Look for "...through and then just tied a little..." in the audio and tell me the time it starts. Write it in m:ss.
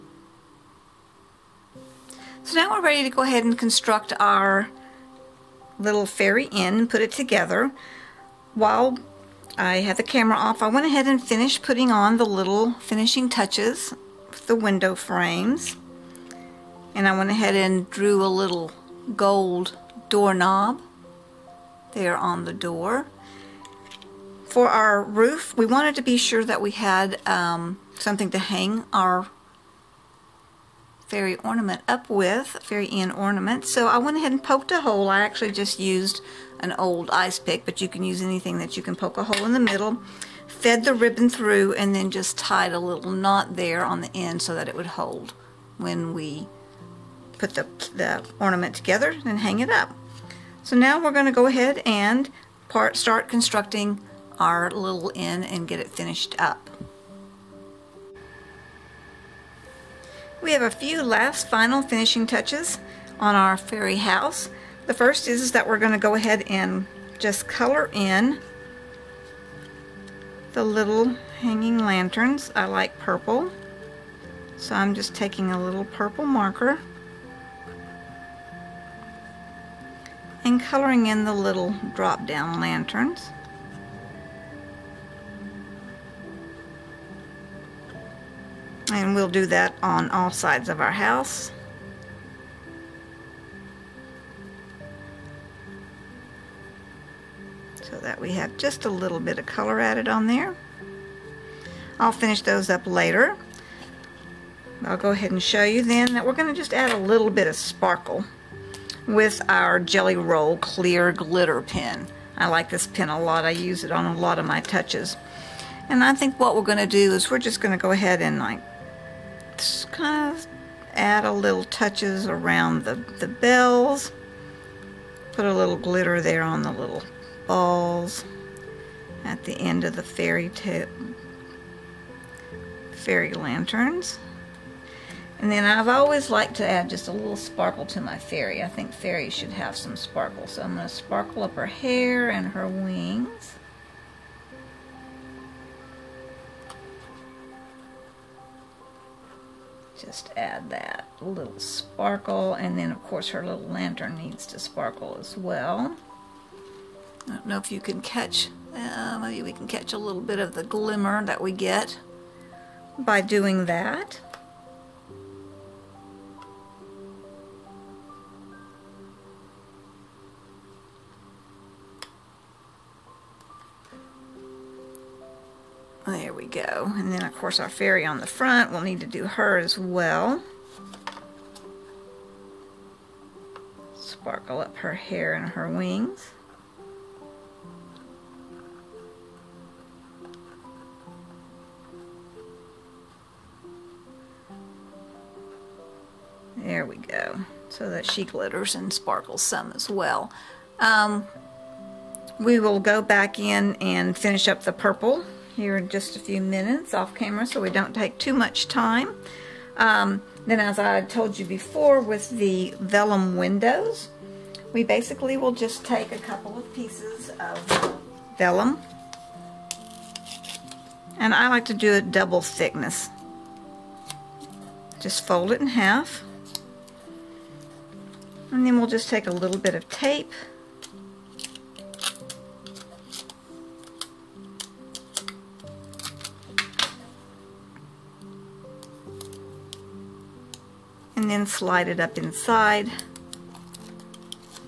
0:41.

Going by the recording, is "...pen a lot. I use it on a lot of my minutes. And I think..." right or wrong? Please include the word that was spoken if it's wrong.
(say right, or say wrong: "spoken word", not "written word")
wrong: "touches", not "minutes".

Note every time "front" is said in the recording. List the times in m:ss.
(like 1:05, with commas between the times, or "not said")
2:58.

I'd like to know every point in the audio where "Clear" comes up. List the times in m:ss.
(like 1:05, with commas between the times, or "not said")
1:50.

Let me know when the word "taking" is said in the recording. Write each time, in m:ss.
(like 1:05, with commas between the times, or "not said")
1:15.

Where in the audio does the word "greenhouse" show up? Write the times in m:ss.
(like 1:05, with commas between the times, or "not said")
not said.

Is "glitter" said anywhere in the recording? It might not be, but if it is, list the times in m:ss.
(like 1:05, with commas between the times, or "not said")
1:51, 2:05, 3:18.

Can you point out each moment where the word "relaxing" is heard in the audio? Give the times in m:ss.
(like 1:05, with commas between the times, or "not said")
not said.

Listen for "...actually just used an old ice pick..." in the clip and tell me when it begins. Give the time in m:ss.
0:35.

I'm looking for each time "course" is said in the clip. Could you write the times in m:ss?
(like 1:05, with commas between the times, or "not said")
2:33, 2:57.